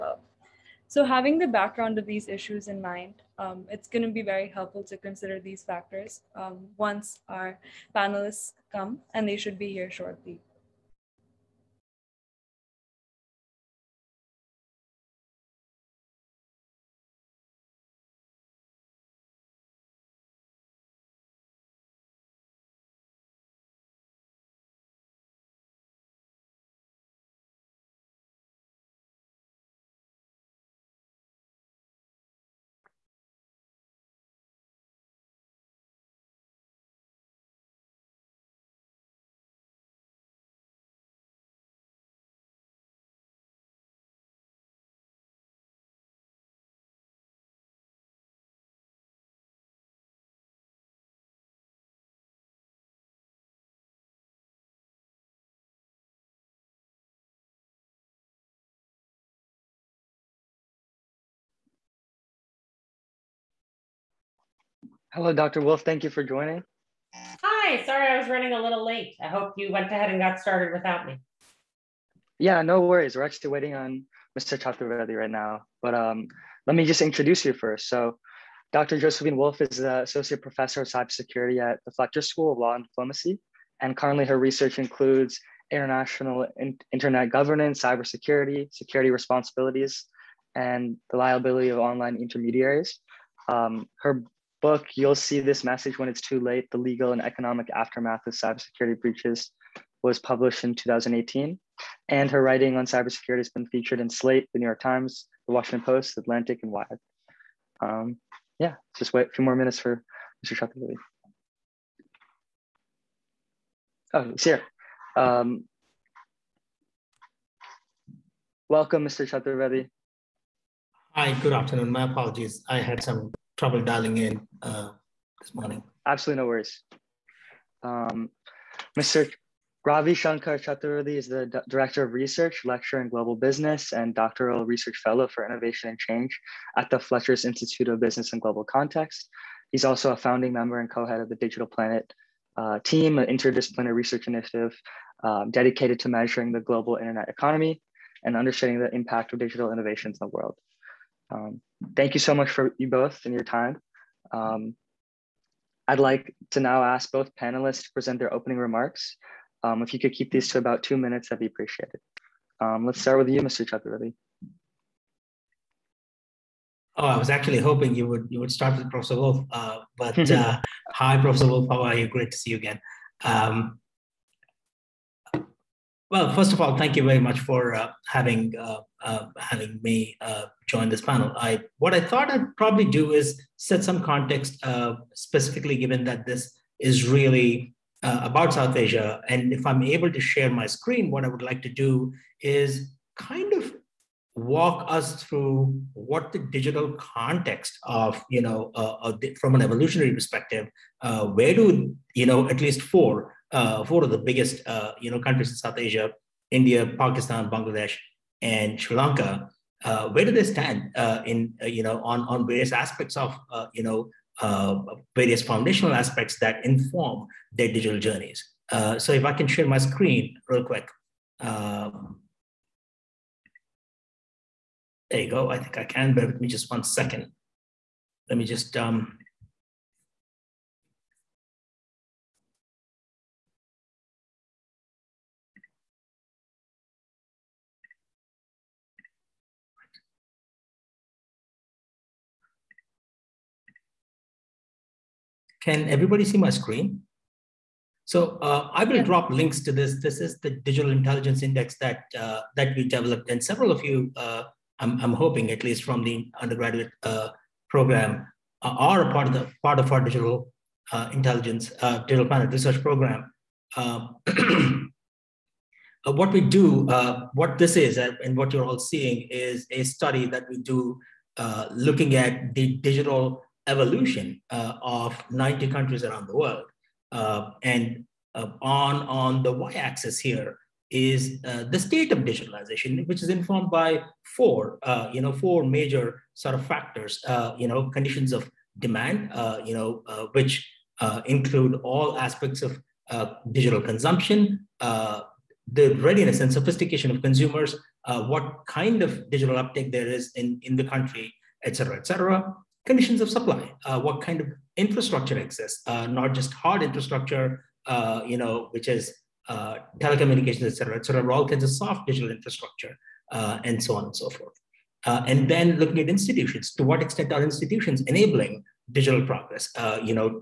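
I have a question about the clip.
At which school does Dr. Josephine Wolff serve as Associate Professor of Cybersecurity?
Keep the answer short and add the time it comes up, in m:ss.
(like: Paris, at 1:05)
Fletcher School of Law and Diplomacy, at 1:21.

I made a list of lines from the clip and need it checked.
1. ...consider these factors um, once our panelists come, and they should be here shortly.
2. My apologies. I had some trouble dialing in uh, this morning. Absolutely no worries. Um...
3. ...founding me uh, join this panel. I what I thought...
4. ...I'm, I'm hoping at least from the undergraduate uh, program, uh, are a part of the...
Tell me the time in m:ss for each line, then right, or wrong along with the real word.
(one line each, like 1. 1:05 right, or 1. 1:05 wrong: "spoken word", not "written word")
1. 0:04 right
2. 2:01 right
3. 2:59 wrong: "having", not "founding"
4. 4:14 right.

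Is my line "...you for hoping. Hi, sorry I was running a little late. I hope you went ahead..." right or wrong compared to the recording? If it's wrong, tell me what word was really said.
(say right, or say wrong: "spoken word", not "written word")
wrong: "joining", not "hoping".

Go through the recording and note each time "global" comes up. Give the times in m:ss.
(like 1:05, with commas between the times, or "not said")
2:13, 2:18, 2:26.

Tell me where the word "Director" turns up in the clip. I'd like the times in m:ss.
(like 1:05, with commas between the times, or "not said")
2:11.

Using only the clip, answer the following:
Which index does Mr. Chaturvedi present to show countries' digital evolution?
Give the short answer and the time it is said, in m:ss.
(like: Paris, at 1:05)
Digital Intelligence Index, at 4:10.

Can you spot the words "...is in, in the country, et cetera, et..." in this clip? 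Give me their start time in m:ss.
5:00.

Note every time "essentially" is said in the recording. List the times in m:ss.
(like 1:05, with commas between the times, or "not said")
not said.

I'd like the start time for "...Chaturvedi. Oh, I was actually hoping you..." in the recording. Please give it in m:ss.
2:43.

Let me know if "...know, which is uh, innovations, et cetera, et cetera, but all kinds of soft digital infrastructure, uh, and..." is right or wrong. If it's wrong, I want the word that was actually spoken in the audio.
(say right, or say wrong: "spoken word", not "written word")
wrong: "telecommunications", not "innovations".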